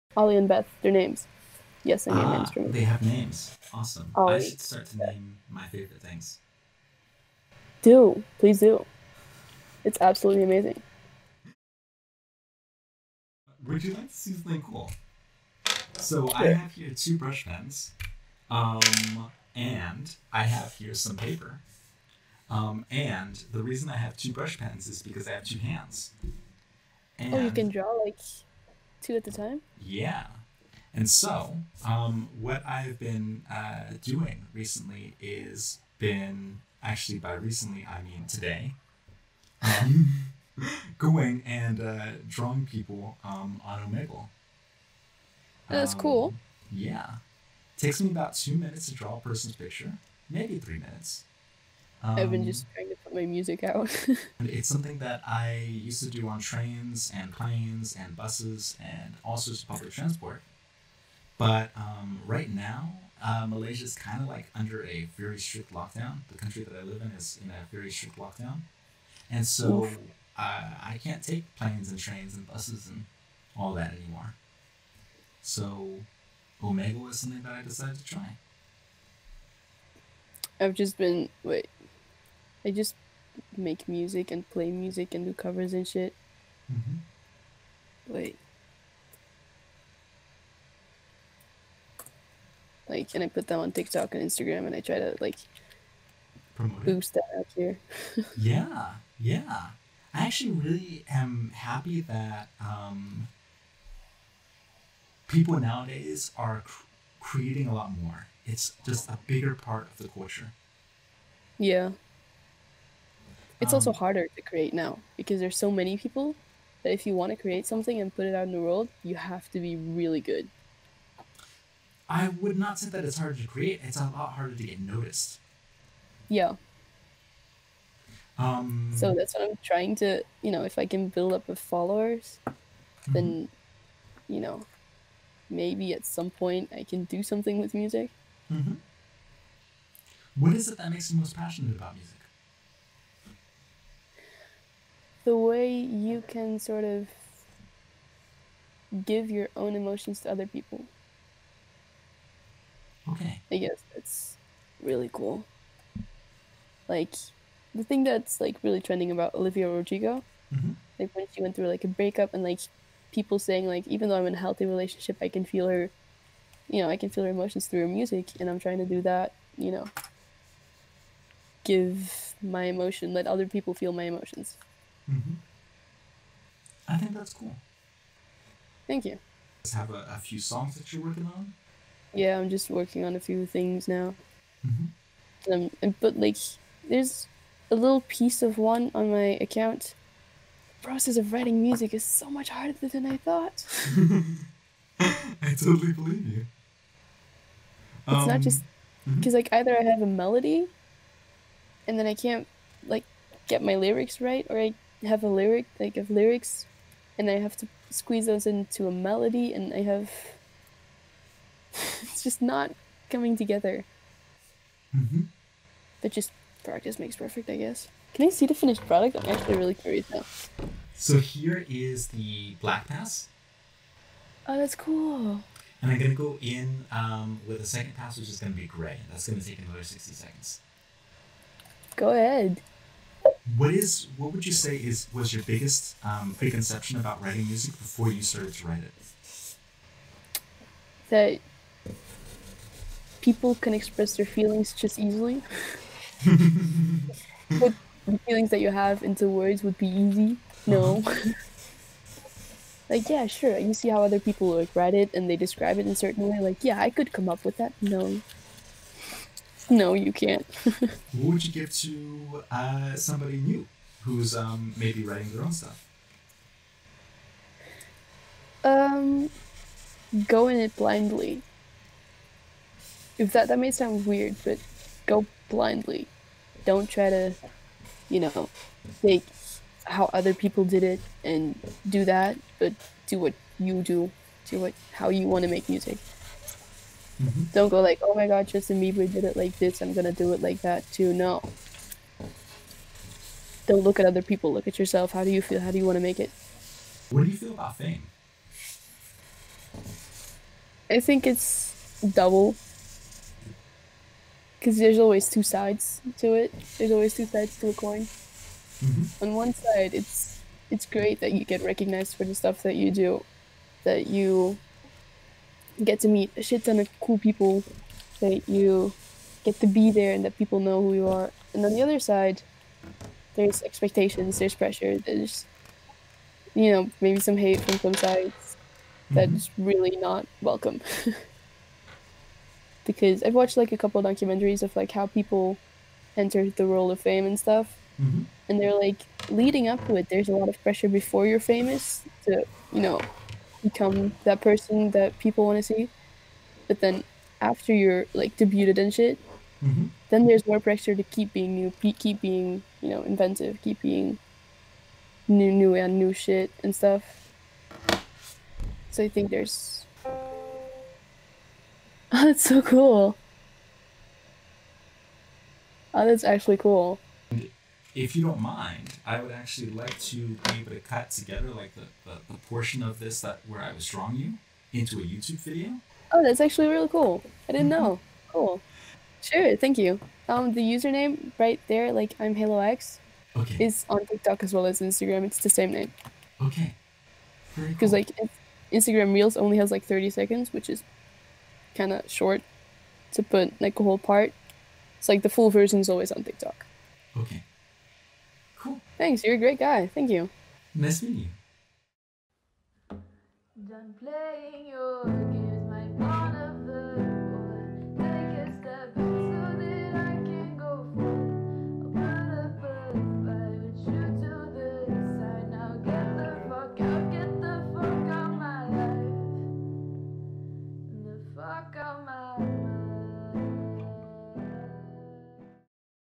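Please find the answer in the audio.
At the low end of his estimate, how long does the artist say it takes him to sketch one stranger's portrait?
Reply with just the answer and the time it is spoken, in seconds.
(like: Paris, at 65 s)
2 minutes, at 48 s.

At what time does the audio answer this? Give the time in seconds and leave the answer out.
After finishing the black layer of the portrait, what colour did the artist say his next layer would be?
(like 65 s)
228 s.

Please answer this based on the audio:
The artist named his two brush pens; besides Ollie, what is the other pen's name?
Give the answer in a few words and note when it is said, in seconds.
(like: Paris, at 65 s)
Beth, at 0 s.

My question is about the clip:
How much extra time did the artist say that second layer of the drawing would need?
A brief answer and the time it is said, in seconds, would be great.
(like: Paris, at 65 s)
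60 seconds, at 229 s.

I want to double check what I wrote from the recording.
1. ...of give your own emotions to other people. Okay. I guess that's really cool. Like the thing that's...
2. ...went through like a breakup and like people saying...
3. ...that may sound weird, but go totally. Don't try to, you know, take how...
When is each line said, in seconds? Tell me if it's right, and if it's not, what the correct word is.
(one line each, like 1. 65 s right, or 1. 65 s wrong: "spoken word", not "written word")
1. 146 s right
2. 161 s right
3. 273 s wrong: "blindly", not "totally".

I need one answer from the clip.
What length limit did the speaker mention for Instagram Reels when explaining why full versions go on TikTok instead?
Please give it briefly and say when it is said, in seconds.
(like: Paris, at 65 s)
30 seconds, at 389 s.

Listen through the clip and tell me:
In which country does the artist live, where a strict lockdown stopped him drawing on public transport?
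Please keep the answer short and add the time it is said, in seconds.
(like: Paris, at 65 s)
Malaysia, at 63 s.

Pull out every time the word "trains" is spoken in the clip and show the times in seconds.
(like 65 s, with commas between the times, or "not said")
56 s, 71 s.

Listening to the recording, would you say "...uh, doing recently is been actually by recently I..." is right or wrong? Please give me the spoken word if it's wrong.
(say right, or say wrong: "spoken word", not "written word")
right.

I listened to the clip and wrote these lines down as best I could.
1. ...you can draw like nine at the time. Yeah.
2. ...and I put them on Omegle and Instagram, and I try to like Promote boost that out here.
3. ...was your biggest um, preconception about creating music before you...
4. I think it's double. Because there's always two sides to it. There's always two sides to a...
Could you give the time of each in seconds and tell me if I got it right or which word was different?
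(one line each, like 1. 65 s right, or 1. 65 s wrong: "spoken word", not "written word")
1. 27 s wrong: "two", not "nine"
2. 93 s wrong: "TikTok", not "Omegle"
3. 235 s wrong: "writing", not "creating"
4. 300 s right.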